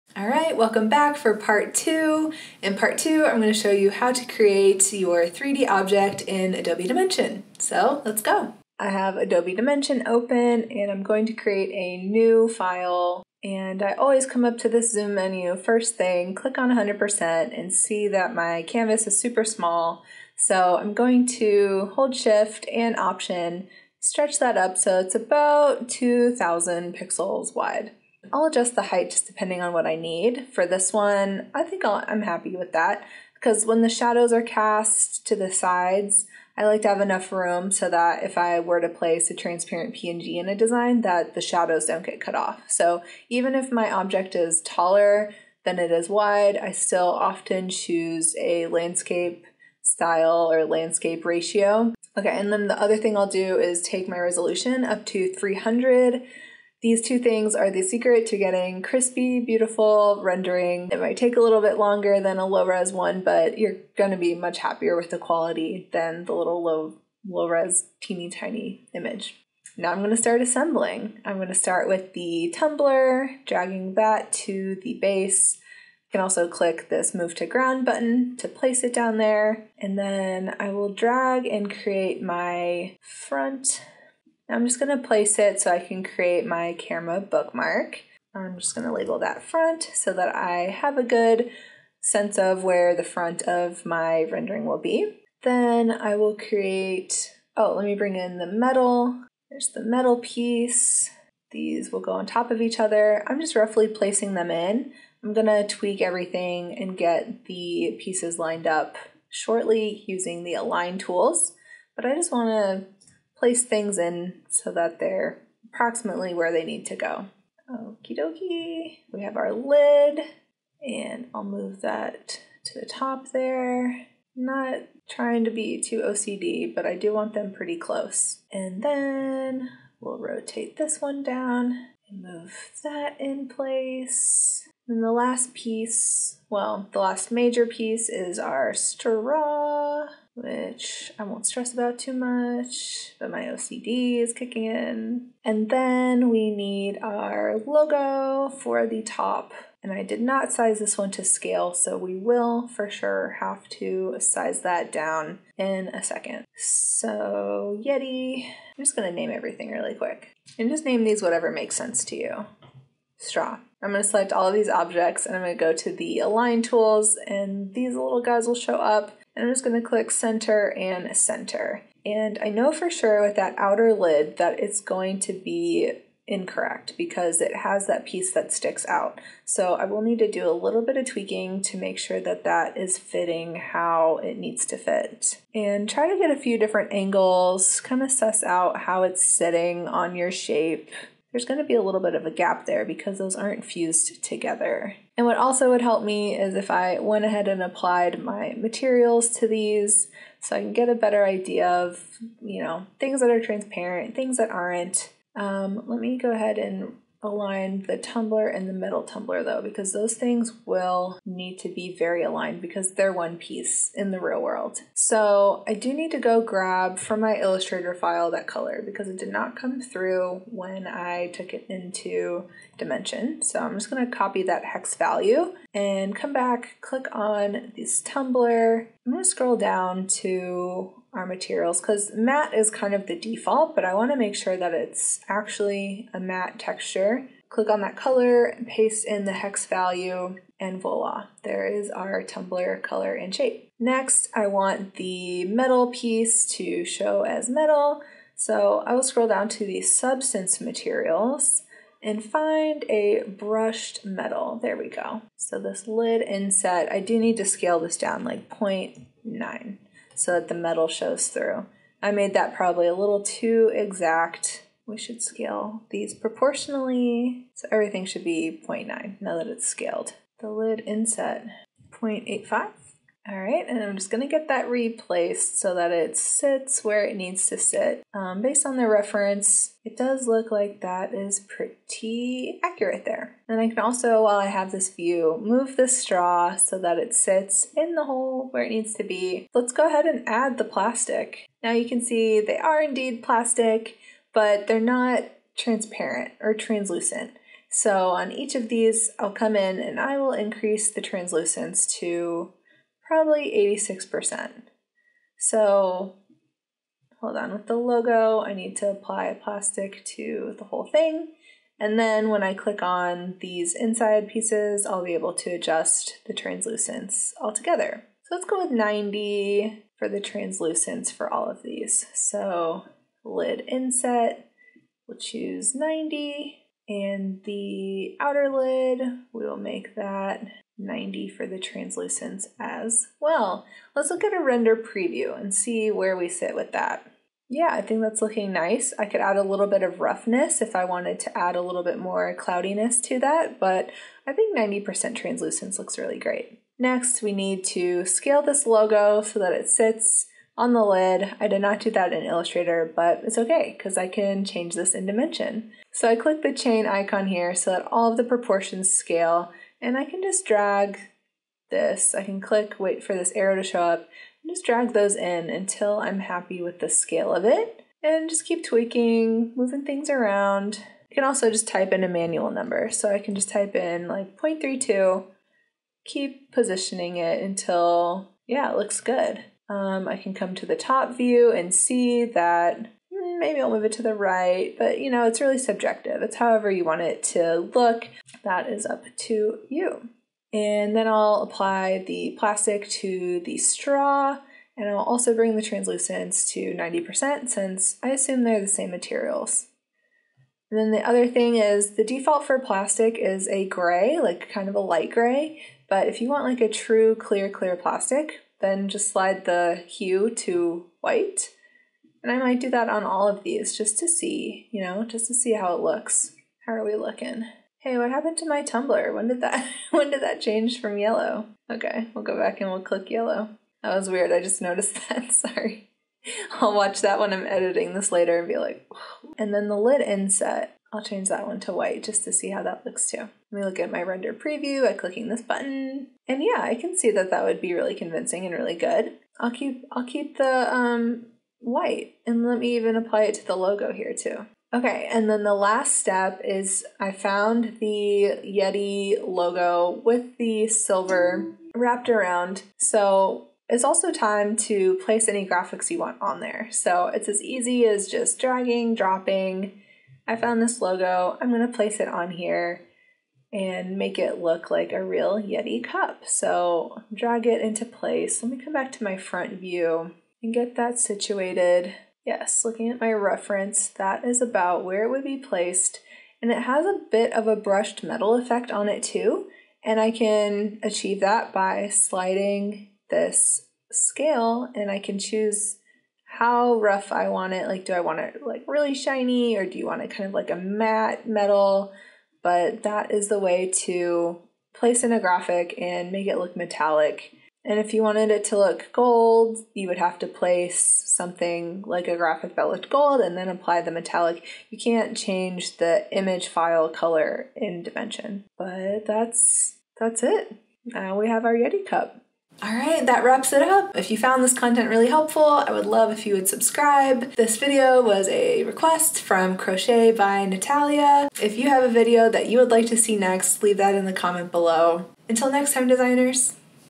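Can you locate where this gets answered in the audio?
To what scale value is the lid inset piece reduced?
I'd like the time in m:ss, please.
4:31.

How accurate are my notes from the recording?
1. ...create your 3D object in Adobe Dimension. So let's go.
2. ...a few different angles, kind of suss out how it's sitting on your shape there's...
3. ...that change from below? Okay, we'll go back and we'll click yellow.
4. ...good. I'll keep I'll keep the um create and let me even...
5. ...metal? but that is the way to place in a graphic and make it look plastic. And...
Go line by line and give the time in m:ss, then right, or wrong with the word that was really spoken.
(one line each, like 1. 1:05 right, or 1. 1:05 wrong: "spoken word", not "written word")
1. 0:04 right
2. 3:06 right
3. 7:00 wrong: "yellow", not "below"
4. 7:18 wrong: "white", not "create"
5. 8:11 wrong: "metallic", not "plastic".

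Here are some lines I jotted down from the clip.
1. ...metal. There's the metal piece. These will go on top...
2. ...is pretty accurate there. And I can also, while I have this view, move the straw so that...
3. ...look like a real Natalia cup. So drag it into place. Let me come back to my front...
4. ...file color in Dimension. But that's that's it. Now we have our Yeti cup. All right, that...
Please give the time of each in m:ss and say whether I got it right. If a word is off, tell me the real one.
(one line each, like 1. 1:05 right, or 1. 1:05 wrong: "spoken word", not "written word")
1. 1:38 right
2. 4:41 right
3. 7:44 wrong: "Yeti", not "Natalia"
4. 8:26 right.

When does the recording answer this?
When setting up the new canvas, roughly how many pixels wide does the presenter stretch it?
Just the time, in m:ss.
0:25.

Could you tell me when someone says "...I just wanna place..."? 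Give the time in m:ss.
1:52.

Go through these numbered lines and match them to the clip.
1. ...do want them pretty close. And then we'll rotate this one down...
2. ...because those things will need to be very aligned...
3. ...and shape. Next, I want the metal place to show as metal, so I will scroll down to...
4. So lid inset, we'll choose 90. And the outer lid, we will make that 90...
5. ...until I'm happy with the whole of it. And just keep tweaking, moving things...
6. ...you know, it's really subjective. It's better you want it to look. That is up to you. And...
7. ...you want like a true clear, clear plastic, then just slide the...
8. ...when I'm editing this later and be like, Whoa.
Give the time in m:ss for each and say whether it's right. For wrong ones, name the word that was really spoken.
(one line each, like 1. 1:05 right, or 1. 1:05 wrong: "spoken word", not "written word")
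1. 2:06 right
2. 3:29 right
3. 4:03 wrong: "piece", not "place"
4. 5:22 right
5. 6:05 wrong: "scale", not "whole"
6. 6:24 wrong: "however", not "better"
7. 6:46 right
8. 7:07 right.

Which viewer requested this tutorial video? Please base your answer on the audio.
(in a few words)
Crochet by Natalia.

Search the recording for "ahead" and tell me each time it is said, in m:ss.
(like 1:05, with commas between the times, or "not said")
3:17, 3:26, 4:49.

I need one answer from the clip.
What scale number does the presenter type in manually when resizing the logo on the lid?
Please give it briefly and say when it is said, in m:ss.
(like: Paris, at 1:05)
0.32, at 6:14.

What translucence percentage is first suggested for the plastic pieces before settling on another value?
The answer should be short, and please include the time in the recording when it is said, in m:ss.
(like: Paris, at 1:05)
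86%, at 5:03.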